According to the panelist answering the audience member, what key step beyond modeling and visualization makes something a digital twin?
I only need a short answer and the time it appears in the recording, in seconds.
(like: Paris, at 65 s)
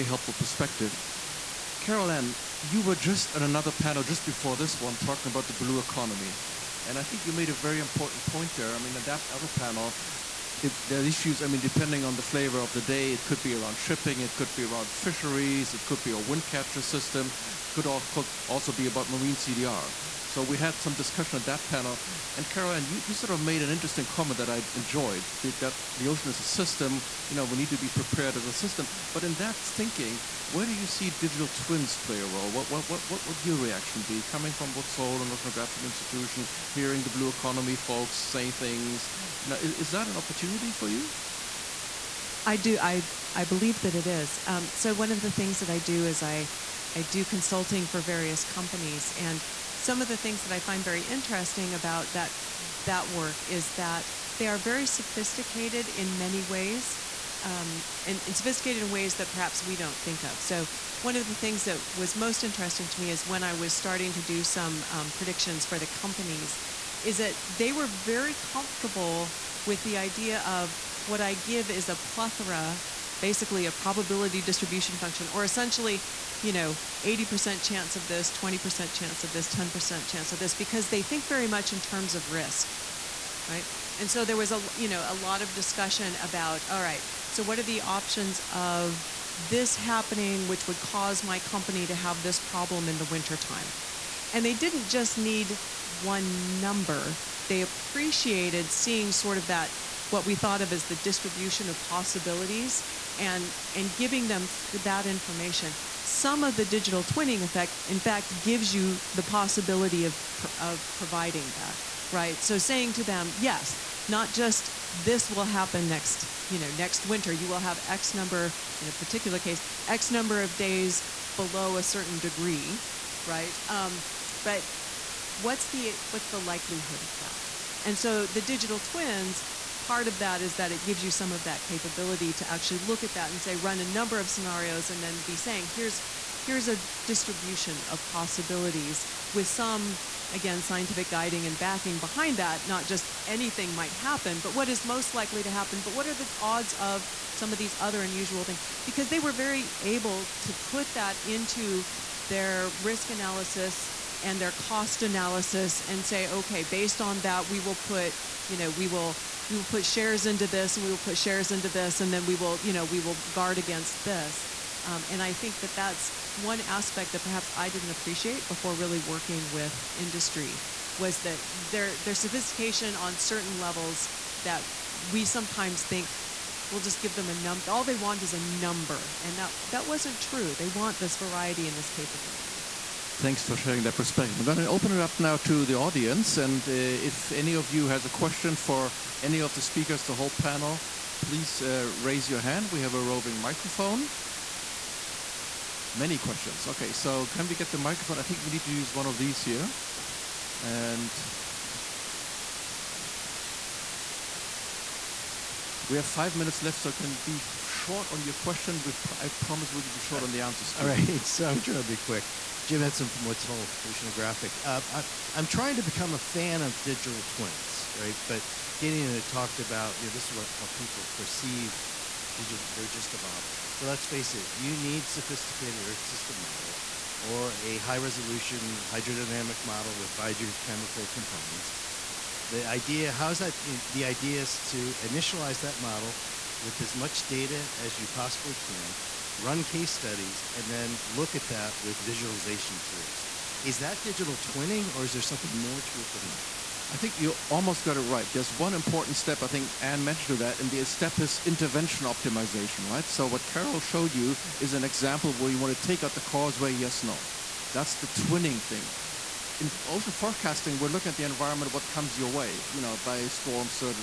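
intervention optimization, at 251 s.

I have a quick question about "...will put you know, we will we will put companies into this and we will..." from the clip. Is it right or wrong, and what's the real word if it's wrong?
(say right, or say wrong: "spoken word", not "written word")
wrong: "shares", not "companies".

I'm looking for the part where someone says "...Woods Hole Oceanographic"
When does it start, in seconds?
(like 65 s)
213 s.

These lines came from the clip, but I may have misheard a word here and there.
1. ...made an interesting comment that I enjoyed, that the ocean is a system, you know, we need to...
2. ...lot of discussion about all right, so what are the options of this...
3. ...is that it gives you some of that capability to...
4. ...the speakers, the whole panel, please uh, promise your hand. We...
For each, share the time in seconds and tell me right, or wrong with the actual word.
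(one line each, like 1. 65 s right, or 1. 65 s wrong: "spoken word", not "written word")
1. 23 s right
2. 85 s right
3. 130 s right
4. 189 s wrong: "raise", not "promise".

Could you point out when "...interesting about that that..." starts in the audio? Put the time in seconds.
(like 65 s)
51 s.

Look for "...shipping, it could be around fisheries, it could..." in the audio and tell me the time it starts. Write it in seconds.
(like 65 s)
13 s.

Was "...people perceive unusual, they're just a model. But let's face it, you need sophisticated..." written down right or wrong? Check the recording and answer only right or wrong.
wrong.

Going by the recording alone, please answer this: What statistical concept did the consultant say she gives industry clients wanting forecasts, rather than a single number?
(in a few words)
probability distribution function.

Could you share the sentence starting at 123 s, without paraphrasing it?
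Um, but what's the, what's the likelihood of that?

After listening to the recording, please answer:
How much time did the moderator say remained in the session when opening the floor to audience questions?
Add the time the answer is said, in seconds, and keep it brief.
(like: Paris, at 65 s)
5 minutes, at 206 s.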